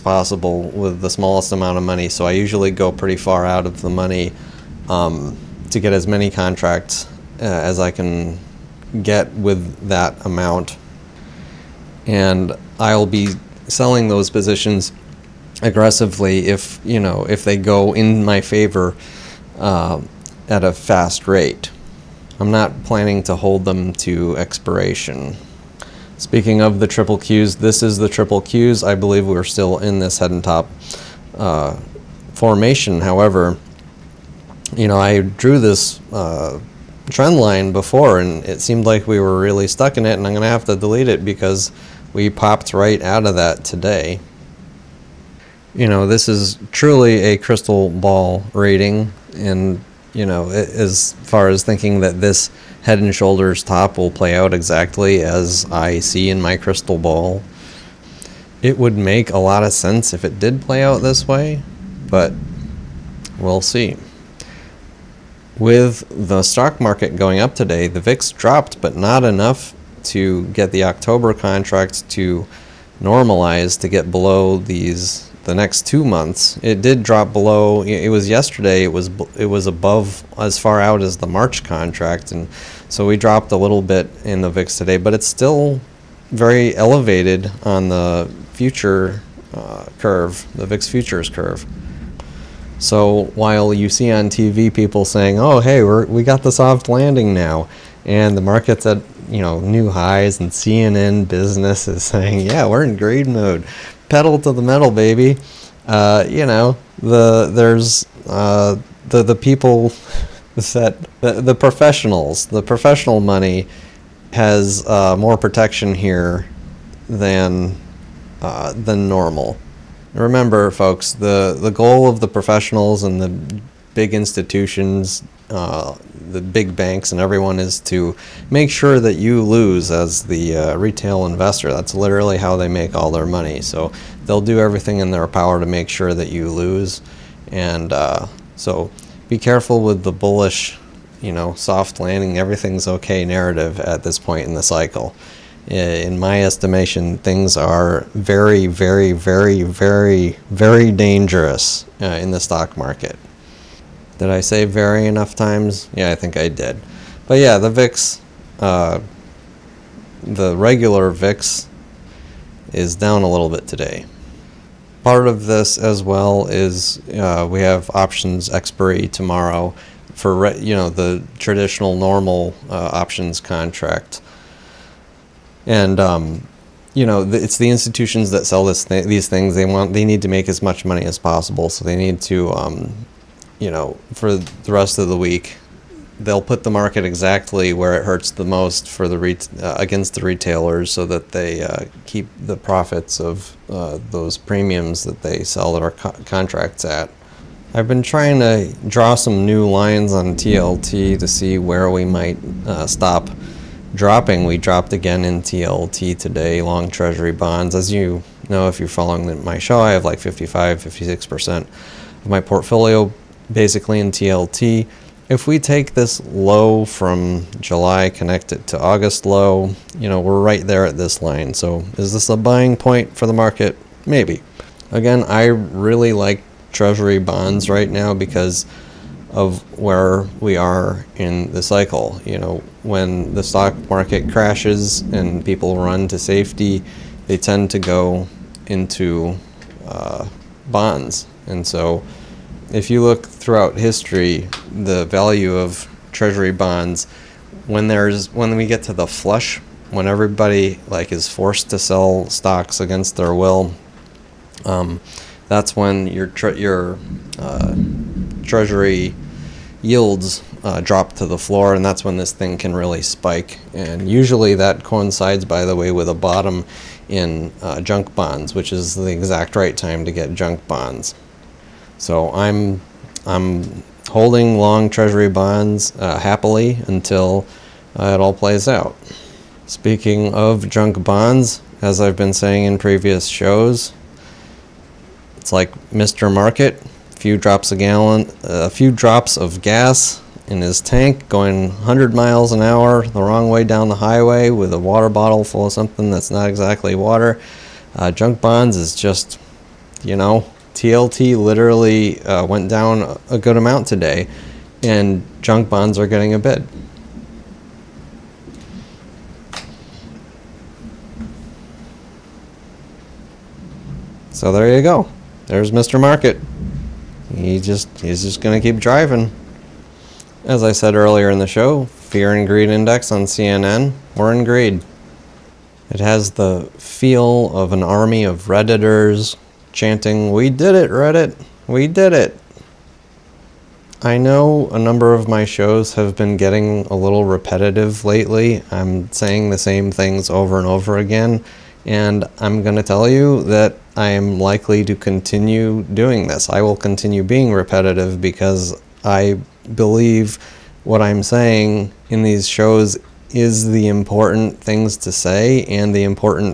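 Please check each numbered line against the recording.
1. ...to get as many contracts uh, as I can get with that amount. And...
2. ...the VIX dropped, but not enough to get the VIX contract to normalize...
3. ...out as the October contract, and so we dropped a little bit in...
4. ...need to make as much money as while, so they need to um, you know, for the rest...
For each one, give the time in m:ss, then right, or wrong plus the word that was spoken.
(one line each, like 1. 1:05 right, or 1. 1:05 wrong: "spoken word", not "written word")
1. 0:05 right
2. 1:07 wrong: "October", not "VIX"
3. 1:20 wrong: "March", not "October"
4. 3:00 wrong: "possible", not "while".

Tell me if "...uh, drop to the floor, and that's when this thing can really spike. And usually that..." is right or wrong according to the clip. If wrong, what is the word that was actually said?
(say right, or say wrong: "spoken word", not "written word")
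right.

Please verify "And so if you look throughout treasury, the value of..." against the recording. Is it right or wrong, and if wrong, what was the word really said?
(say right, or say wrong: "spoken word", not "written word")
wrong: "history", not "treasury".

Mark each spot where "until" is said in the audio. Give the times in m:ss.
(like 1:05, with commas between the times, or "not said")
4:36.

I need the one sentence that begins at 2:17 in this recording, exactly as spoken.
And uh, so be careful with the bullish, you know, soft landing, everything's okay narrative at this point in the cycle.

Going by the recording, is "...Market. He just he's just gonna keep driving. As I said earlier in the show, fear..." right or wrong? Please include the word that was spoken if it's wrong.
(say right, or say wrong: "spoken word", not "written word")
right.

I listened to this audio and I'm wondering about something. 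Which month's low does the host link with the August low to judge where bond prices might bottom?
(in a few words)
July.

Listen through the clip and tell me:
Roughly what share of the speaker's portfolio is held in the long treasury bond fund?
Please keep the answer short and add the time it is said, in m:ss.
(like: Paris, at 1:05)
55-56%, at 3:30.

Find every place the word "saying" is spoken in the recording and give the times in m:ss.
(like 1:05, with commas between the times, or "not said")
1:35, 1:42, 4:42, 5:39, 5:51.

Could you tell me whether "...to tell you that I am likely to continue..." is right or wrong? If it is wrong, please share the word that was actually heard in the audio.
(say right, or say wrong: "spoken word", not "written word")
right.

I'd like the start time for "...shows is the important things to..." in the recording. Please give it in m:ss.
5:52.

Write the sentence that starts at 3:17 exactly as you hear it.
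I've been trying to draw some new lines on TLT to see where we might uh, stop dropping.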